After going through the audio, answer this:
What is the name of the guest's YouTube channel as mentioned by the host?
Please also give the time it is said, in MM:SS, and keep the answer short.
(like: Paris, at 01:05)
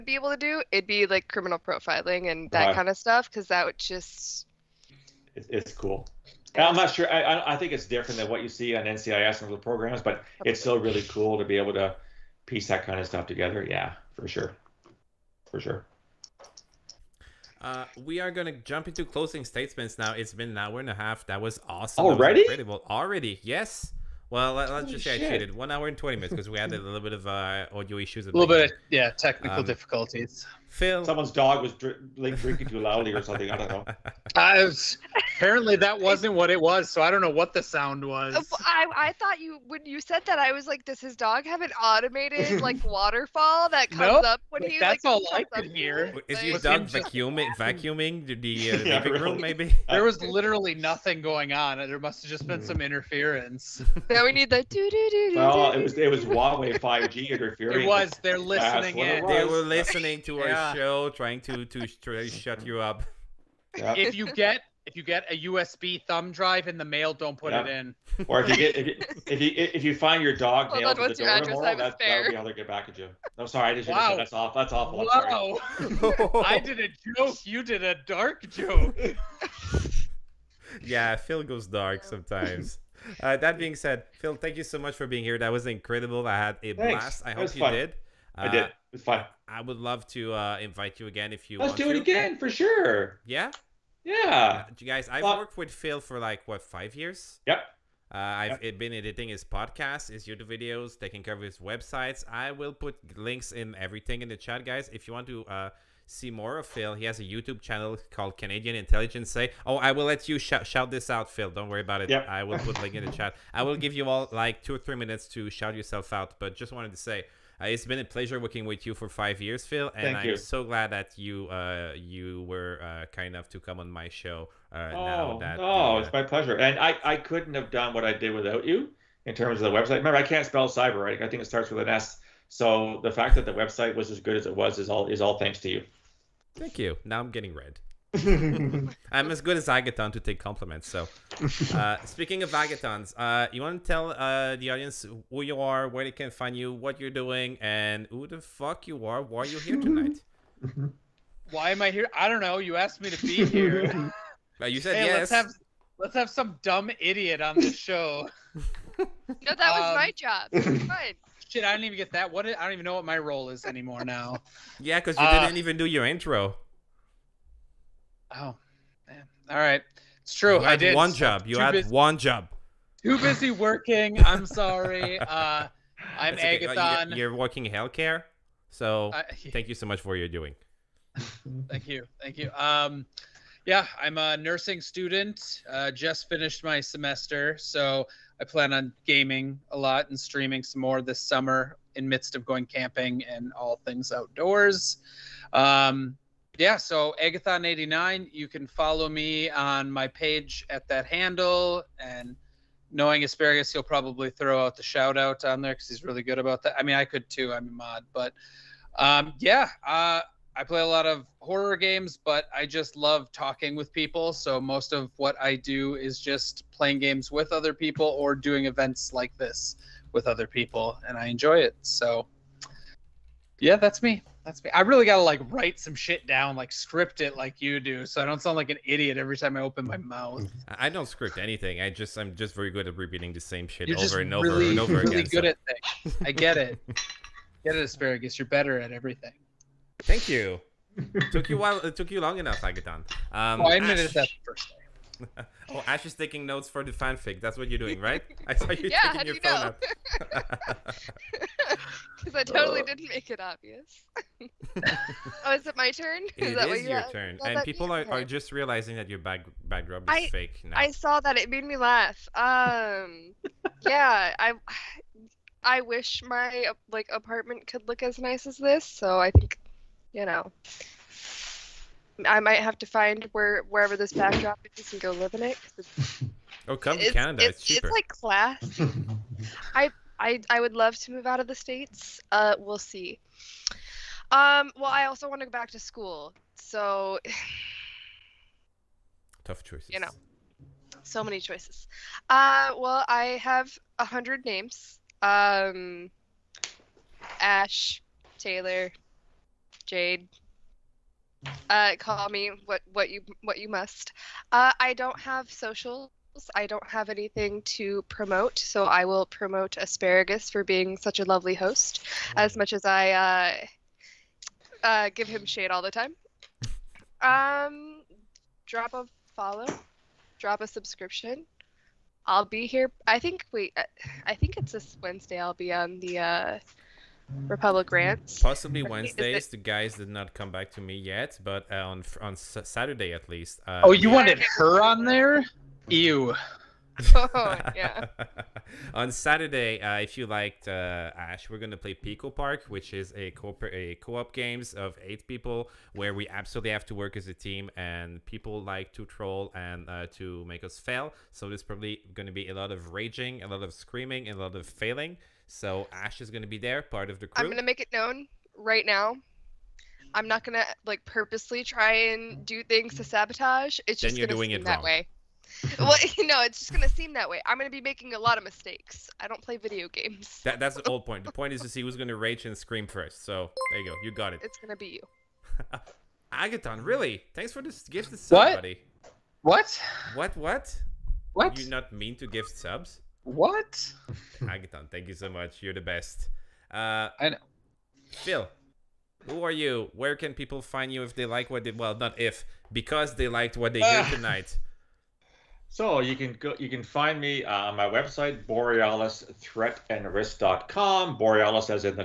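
Canadian Intelligence Say, at 01:48.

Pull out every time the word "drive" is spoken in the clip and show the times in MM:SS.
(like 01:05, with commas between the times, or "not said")
01:06.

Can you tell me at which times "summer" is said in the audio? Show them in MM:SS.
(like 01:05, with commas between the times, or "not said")
03:11.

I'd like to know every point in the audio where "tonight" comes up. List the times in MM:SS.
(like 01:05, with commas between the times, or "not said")
02:29, 06:34.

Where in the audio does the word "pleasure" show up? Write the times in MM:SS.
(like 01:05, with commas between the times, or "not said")
01:58, 02:06.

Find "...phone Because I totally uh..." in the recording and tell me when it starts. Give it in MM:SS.
04:09.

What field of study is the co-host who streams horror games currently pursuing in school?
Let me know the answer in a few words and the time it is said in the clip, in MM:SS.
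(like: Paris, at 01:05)
Nursing, at 03:04.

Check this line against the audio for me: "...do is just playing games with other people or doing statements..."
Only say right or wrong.
wrong.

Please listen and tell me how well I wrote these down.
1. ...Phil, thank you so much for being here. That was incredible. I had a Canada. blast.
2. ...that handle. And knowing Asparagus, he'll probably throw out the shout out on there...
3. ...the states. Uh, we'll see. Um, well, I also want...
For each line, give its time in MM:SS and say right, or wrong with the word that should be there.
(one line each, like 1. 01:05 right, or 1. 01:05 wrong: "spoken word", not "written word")
1. 01:24 wrong: "Thanks", not "Canada"
2. 03:20 right
3. 04:41 right.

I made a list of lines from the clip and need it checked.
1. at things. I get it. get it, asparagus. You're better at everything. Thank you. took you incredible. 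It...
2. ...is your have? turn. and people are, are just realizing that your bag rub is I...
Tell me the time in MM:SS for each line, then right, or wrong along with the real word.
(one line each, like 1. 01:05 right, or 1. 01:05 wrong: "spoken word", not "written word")
1. 03:55 wrong: "while", not "incredible"
2. 04:16 right.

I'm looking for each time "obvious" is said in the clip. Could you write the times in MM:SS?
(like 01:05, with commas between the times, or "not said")
04:13.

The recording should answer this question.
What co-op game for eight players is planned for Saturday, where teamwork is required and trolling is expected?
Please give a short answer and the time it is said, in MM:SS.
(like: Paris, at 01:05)
Pico Park, at 05:41.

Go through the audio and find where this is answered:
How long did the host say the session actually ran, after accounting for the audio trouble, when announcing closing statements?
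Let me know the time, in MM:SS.
00:25.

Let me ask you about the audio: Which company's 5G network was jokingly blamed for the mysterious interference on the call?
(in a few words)
Huawei.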